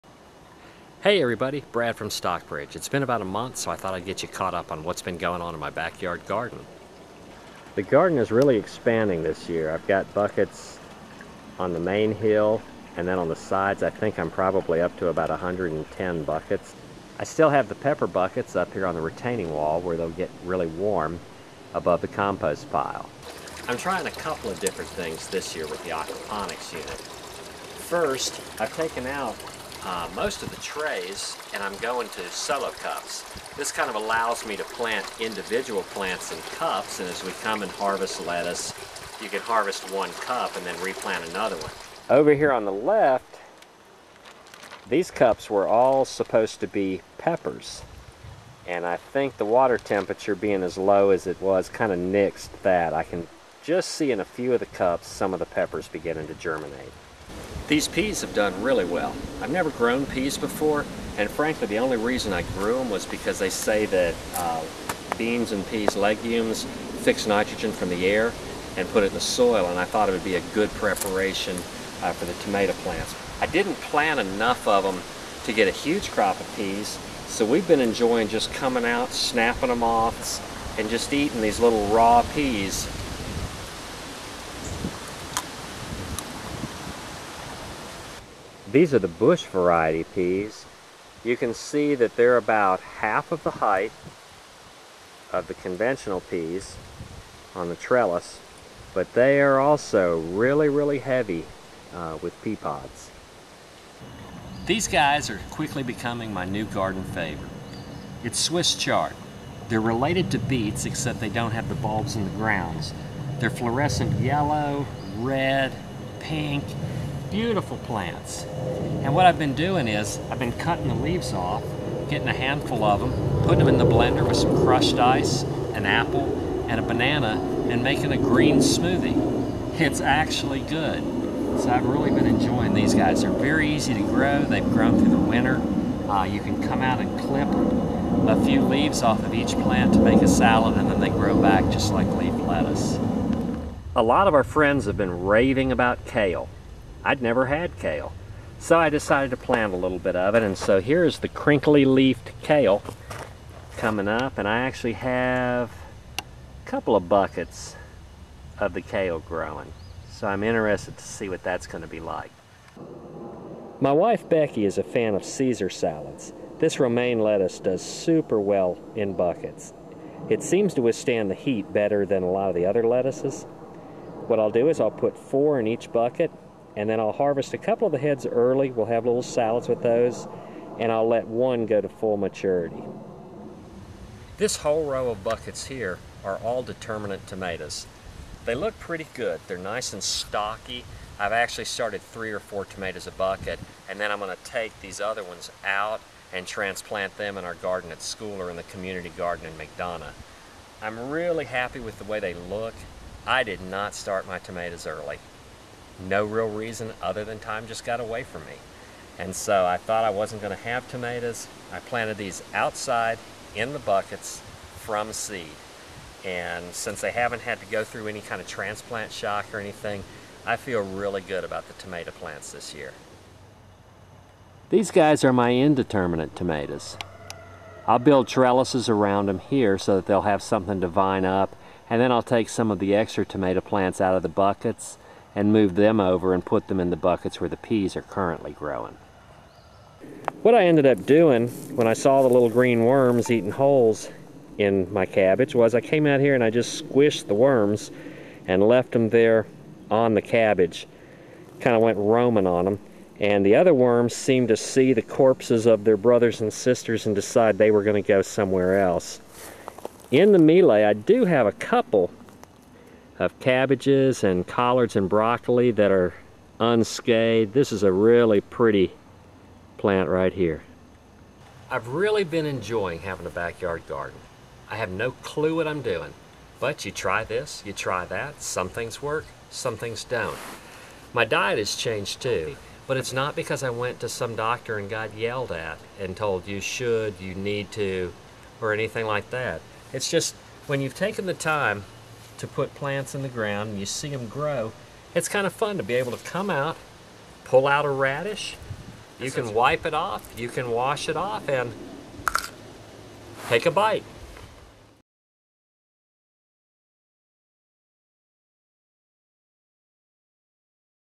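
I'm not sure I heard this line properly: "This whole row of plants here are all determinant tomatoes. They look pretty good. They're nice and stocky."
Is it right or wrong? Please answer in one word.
wrong.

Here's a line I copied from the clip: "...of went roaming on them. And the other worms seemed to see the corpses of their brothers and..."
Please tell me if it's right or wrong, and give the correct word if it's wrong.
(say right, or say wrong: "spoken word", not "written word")
right.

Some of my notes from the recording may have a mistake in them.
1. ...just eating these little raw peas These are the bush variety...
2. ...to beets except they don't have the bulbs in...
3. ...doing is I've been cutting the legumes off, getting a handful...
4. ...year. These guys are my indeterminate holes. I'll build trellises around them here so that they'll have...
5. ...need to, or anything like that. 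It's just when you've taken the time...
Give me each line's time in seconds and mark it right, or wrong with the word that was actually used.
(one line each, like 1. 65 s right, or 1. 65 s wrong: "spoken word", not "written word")
1. 80 s right
2. 110 s right
3. 119 s wrong: "leaves", not "legumes"
4. 222 s wrong: "tomatoes", not "holes"
5. 287 s right.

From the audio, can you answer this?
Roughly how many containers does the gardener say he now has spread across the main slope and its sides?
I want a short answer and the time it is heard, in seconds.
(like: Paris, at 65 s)
110, at 15 s.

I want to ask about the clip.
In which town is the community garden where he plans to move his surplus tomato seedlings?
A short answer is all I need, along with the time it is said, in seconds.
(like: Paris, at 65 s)
McDonough, at 199 s.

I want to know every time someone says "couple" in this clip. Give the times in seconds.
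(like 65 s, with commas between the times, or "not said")
24 s, 156 s, 177 s, 261 s.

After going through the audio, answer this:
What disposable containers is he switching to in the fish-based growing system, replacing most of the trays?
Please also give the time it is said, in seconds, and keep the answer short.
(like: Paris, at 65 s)
solo cups, at 32 s.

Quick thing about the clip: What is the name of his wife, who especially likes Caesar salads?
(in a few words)
Becky.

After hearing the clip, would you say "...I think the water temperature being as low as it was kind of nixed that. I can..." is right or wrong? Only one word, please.
right.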